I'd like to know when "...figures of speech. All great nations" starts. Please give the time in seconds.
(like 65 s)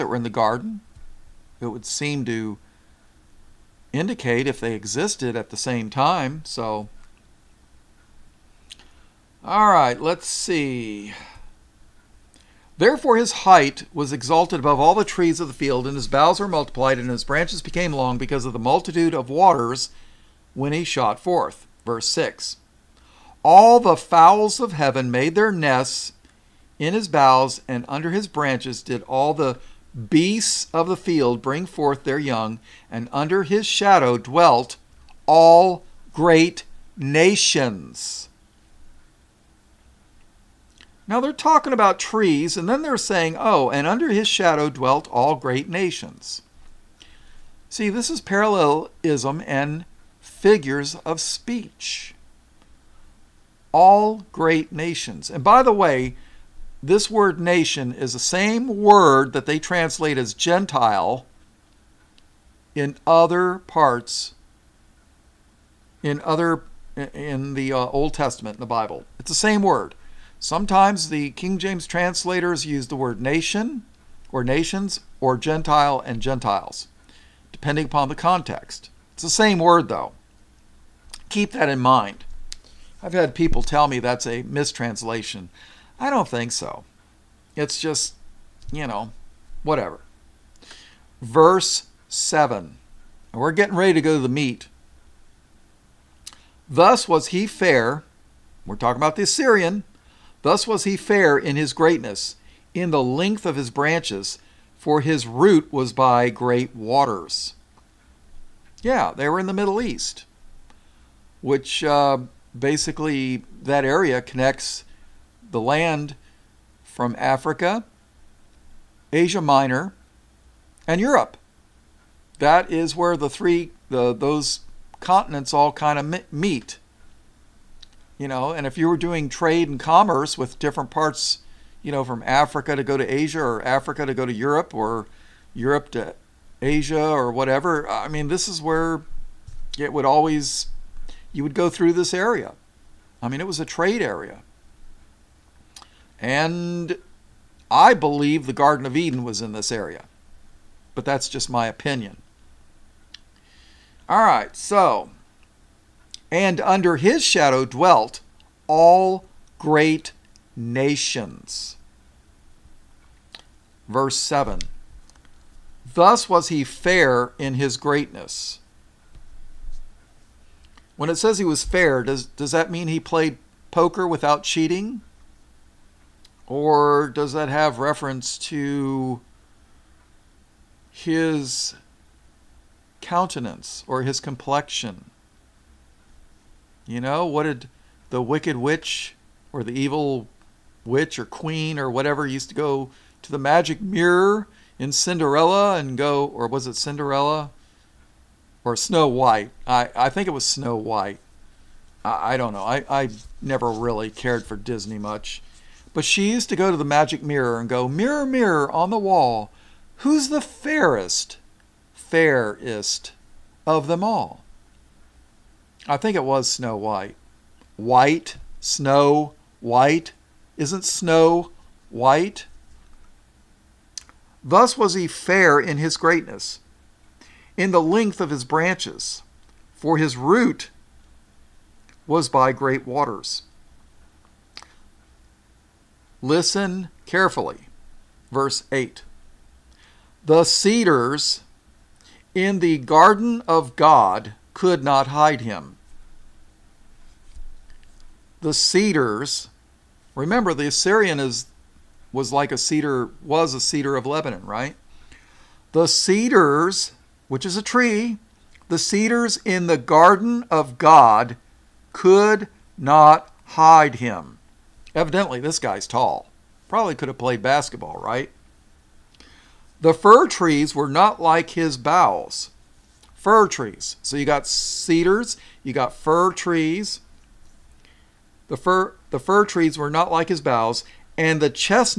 50 s.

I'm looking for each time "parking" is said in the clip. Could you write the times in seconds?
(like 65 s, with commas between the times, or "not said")
not said.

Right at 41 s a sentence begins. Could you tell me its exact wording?
Now they're talking about trees, and then they're saying, oh, and under his shadow dwelt all great nations.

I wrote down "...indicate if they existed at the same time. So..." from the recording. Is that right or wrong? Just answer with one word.
right.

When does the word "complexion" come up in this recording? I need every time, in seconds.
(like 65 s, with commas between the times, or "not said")
184 s.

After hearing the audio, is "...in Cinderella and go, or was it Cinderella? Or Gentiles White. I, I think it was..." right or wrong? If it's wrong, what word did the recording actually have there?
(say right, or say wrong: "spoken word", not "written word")
wrong: "Snow", not "Gentiles".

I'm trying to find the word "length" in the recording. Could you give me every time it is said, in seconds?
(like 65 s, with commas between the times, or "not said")
103 s, 227 s.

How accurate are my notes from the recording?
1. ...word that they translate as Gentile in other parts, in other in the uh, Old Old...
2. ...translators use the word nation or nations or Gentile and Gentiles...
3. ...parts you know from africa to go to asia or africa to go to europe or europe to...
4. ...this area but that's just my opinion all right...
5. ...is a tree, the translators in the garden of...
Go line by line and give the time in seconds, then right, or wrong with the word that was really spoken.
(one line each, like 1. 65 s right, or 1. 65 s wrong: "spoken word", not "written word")
1. 58 s wrong: "Testament", not "Old"
2. 71 s right
3. 130 s right
4. 149 s right
5. 257 s wrong: "cedars", not "translators".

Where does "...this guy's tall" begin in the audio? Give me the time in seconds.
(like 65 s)
265 s.